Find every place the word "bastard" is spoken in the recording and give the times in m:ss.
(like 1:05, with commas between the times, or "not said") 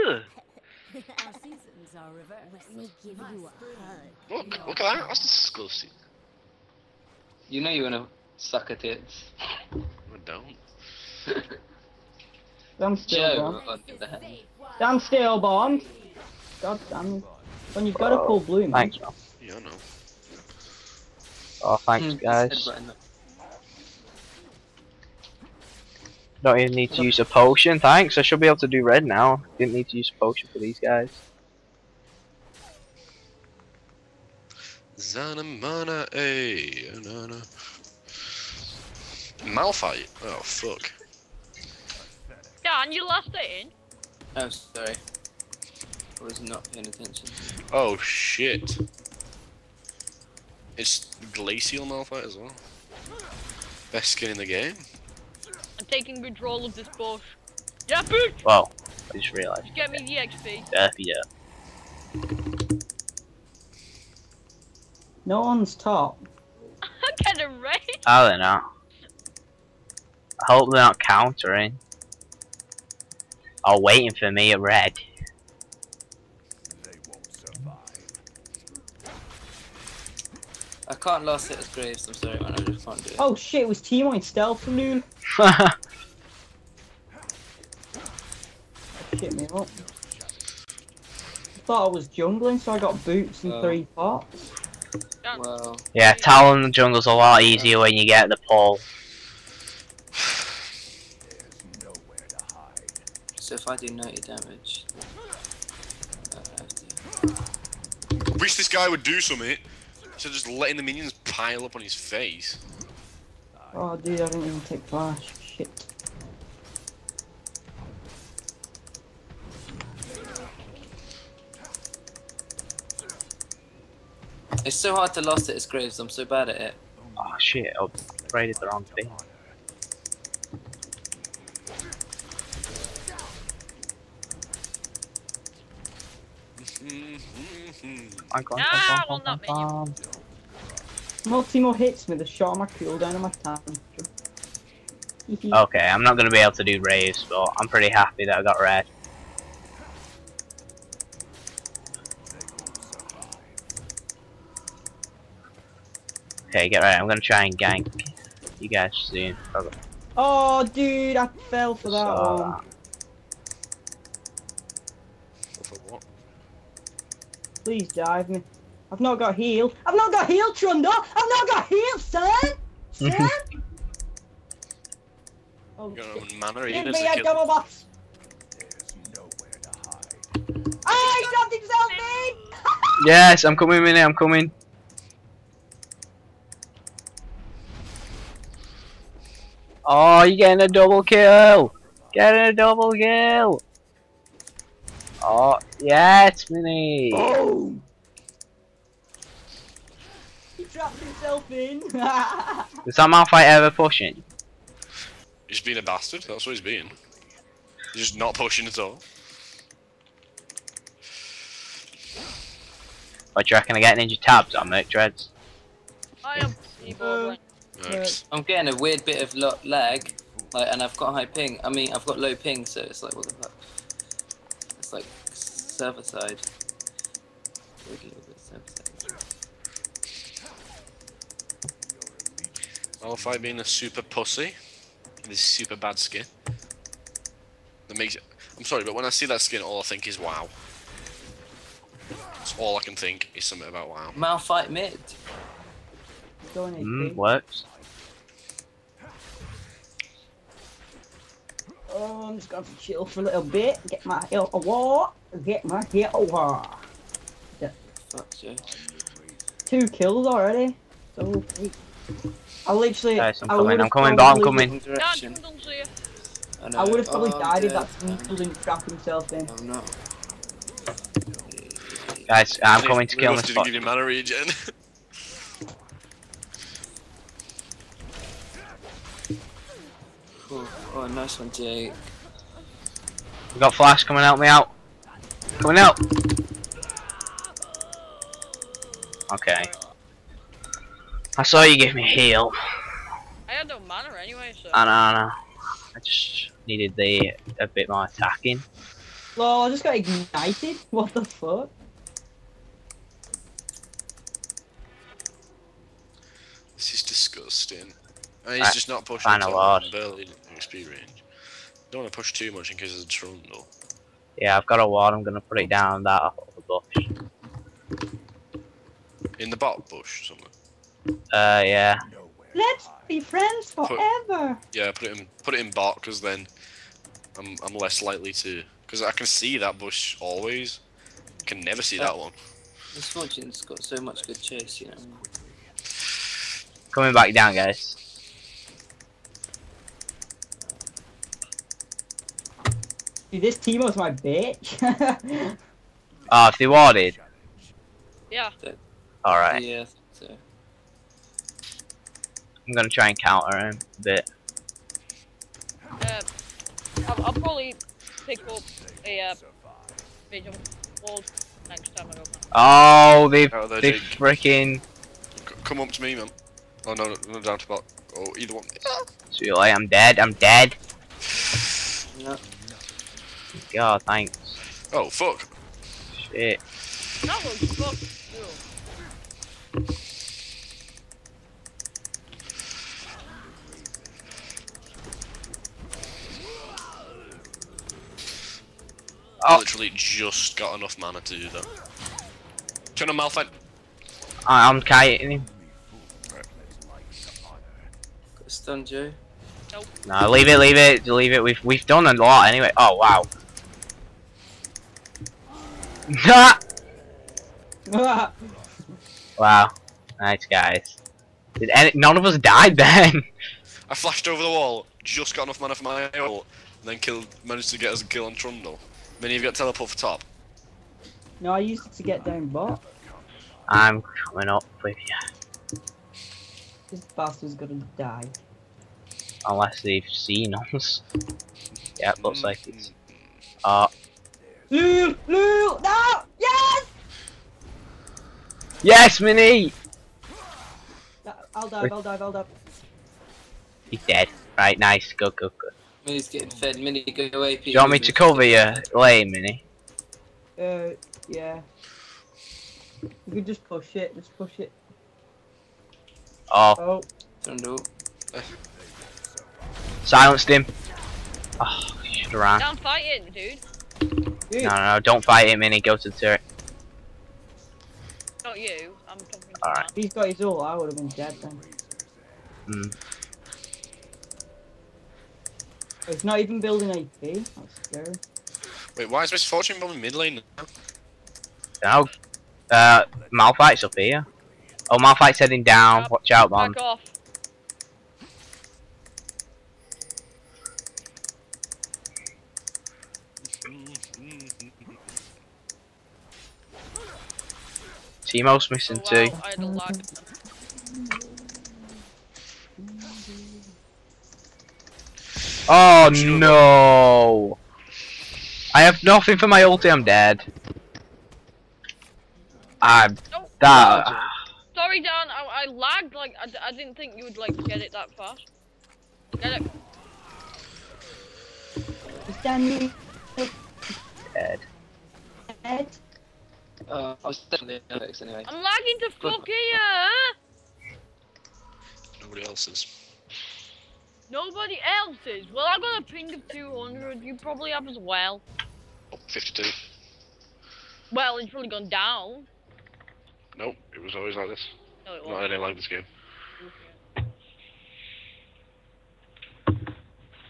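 3:25, 7:07.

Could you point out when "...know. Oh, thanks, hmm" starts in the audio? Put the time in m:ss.
0:19.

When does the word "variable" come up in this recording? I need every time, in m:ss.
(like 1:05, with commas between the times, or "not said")
not said.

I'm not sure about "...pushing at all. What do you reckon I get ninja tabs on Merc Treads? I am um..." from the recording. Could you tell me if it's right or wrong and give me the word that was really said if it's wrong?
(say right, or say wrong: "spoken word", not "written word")
right.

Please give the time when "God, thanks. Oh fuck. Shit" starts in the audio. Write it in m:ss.
6:13.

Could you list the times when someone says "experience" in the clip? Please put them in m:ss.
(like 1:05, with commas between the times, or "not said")
5:10.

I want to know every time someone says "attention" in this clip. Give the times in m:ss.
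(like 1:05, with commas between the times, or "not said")
0:46.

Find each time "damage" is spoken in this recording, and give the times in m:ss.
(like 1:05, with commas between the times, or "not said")
1:44.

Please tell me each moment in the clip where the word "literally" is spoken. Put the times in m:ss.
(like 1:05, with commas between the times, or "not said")
4:22, 6:29.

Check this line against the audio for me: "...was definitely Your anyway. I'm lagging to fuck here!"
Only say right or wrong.
wrong.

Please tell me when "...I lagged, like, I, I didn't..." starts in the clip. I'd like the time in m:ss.
8:35.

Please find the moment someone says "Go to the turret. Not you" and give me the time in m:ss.
7:45.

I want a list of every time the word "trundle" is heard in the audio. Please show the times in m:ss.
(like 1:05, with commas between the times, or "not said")
2:50, 5:13, 6:58.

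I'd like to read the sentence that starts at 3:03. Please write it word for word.
yes, I'm coming, Minnie, I'm coming.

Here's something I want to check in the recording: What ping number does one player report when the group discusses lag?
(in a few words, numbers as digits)
52.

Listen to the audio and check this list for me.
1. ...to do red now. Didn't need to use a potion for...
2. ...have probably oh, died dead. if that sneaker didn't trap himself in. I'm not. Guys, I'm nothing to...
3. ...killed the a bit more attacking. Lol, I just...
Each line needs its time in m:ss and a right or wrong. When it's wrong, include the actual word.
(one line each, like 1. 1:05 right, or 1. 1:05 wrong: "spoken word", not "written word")
1. 0:28 right
2. 4:26 wrong: "coming", not "nothing"
3. 4:56 wrong: "needed", not "killed".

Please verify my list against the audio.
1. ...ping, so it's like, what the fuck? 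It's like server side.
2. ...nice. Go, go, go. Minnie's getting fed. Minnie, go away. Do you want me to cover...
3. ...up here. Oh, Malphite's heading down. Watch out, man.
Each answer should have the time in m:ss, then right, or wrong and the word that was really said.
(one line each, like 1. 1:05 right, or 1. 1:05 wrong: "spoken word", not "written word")
1. 3:42 right
2. 7:24 right
3. 8:03 right.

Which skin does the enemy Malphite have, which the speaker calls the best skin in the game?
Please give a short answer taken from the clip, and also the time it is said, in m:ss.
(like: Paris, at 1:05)
Glacial, at 0:51.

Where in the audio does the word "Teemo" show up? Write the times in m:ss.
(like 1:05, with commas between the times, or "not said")
1:23, 2:21, 5:43, 8:18.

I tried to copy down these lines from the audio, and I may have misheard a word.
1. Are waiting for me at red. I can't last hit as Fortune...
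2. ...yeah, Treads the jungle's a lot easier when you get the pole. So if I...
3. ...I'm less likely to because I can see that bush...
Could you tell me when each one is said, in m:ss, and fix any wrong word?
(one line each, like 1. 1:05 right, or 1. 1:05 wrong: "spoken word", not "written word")
1. 1:13 wrong: "Graves", not "Fortune"
2. 1:35 wrong: "Talon", not "Treads"
3. 5:27 right.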